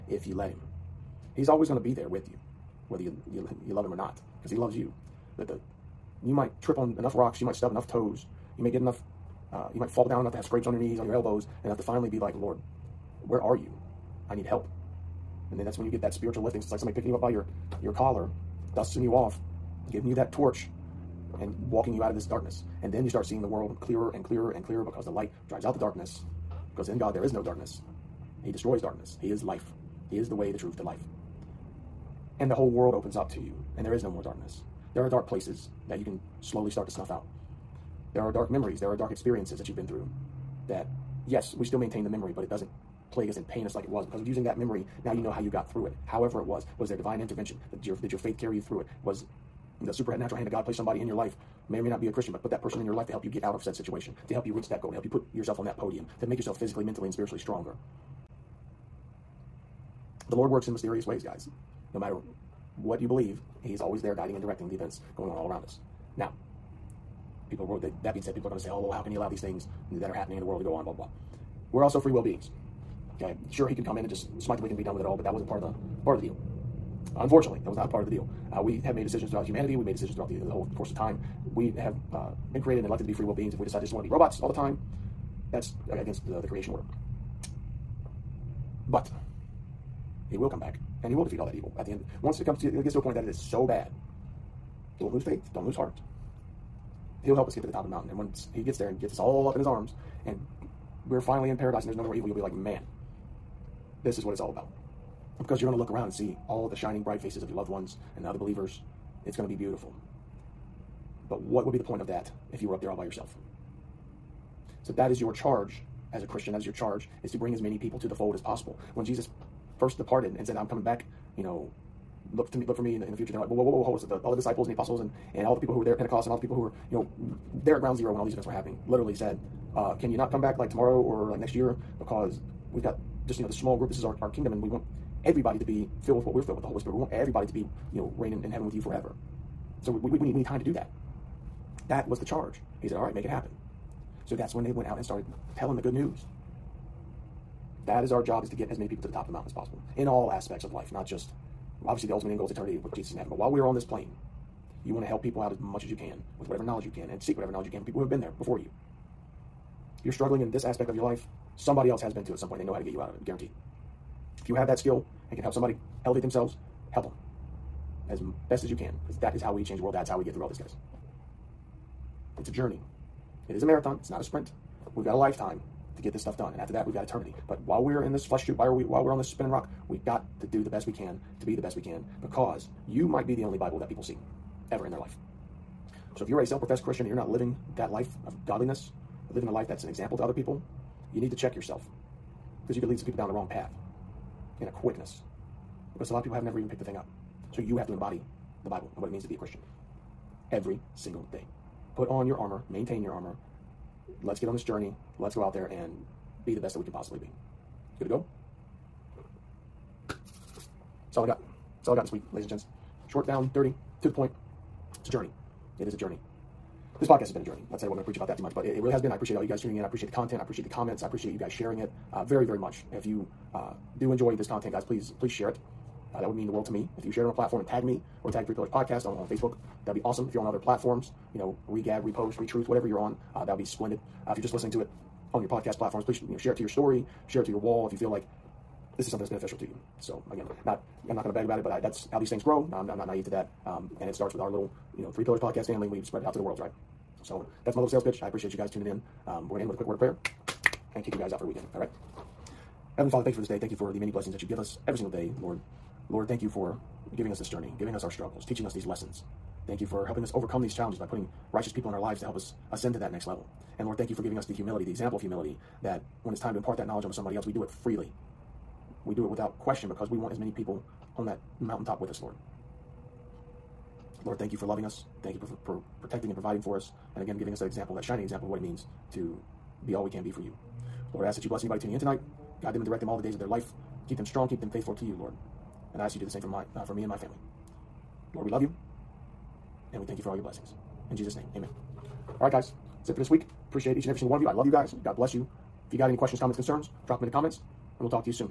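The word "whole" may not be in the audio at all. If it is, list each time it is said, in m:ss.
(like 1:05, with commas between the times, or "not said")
0:32, 1:20.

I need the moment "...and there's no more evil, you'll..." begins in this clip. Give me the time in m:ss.
1:41.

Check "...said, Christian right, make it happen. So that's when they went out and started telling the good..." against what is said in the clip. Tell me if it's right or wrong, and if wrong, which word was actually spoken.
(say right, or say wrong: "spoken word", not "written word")
wrong: "All", not "Christian".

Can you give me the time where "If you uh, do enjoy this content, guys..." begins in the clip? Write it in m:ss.
3:42.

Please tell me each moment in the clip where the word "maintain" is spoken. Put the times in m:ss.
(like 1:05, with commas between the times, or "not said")
0:41, 3:22.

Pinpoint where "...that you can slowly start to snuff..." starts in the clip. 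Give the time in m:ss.
0:35.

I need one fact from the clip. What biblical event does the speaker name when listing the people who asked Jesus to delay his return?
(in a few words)
Pentecost.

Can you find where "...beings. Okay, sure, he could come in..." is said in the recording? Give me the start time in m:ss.
1:12.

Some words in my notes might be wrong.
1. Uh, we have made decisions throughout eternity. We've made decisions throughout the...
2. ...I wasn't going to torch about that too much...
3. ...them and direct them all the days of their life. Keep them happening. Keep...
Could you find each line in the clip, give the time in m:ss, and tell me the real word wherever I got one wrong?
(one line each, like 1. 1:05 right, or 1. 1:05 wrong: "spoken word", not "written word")
1. 1:18 wrong: "humanity", not "eternity"
2. 3:37 wrong: "preach", not "torch"
3. 4:42 wrong: "strong", not "happening".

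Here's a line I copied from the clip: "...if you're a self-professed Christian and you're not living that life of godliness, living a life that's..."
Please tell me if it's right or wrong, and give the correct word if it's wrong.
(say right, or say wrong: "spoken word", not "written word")
right.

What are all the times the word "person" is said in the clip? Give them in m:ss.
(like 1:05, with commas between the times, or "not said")
0:52.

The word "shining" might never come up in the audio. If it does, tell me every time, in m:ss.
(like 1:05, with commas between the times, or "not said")
1:46, 4:38.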